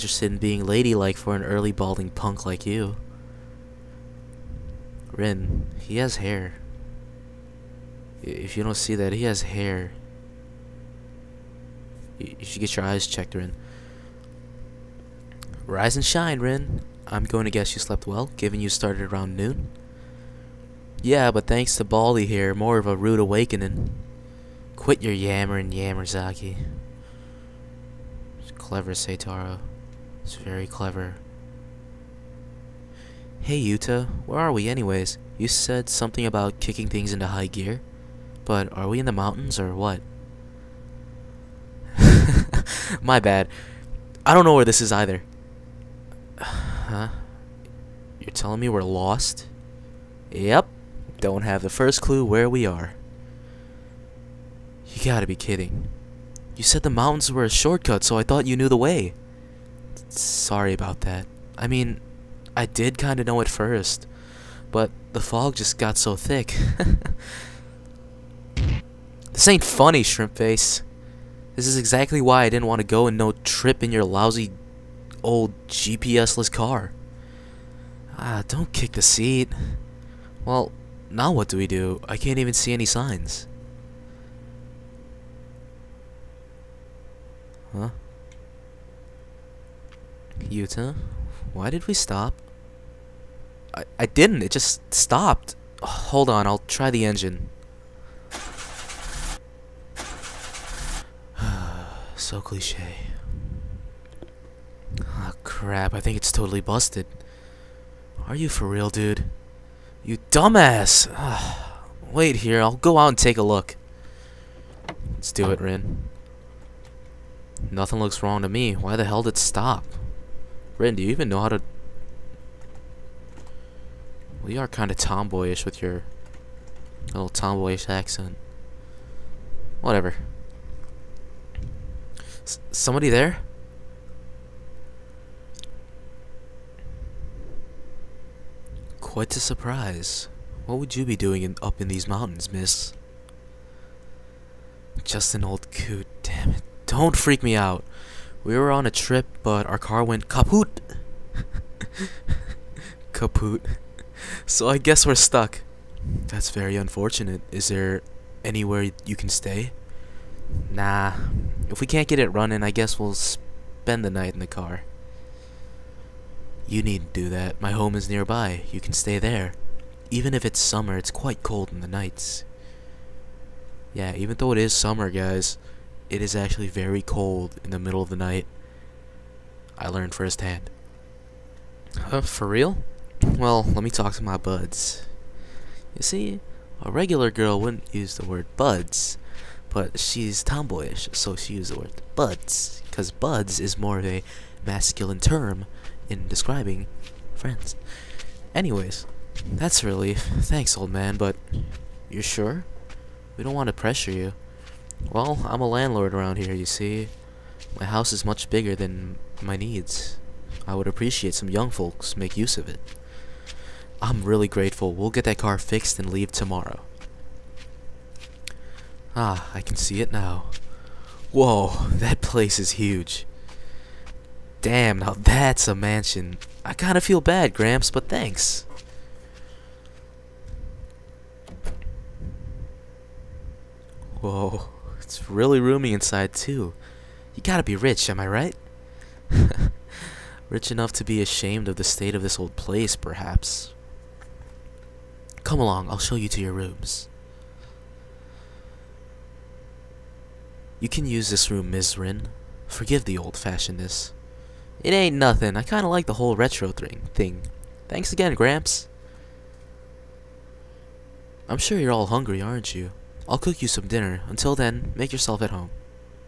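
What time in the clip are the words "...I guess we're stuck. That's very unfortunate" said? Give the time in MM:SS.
02:34.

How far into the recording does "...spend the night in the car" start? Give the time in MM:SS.
02:43.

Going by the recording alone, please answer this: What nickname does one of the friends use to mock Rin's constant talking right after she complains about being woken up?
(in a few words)
Yammerzaki.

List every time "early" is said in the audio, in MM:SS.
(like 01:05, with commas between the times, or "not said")
00:01.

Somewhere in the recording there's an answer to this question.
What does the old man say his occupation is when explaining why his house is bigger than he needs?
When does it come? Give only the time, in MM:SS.
03:25.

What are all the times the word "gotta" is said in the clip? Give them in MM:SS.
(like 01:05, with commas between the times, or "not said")
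00:55, 03:57.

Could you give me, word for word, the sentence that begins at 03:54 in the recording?
Whoa, it's really roomy inside too.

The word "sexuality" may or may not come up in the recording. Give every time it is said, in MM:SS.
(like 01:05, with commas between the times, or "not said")
not said.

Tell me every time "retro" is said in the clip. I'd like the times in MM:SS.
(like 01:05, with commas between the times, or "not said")
04:16.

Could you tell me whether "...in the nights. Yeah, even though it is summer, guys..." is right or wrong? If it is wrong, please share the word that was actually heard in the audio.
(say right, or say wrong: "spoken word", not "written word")
right.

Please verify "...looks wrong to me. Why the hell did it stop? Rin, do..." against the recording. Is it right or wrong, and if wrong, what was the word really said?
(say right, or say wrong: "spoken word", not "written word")
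right.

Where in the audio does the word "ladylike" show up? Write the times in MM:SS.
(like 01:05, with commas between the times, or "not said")
00:00.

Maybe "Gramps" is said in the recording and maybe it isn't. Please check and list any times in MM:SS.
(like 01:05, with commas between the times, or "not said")
03:47, 04:18.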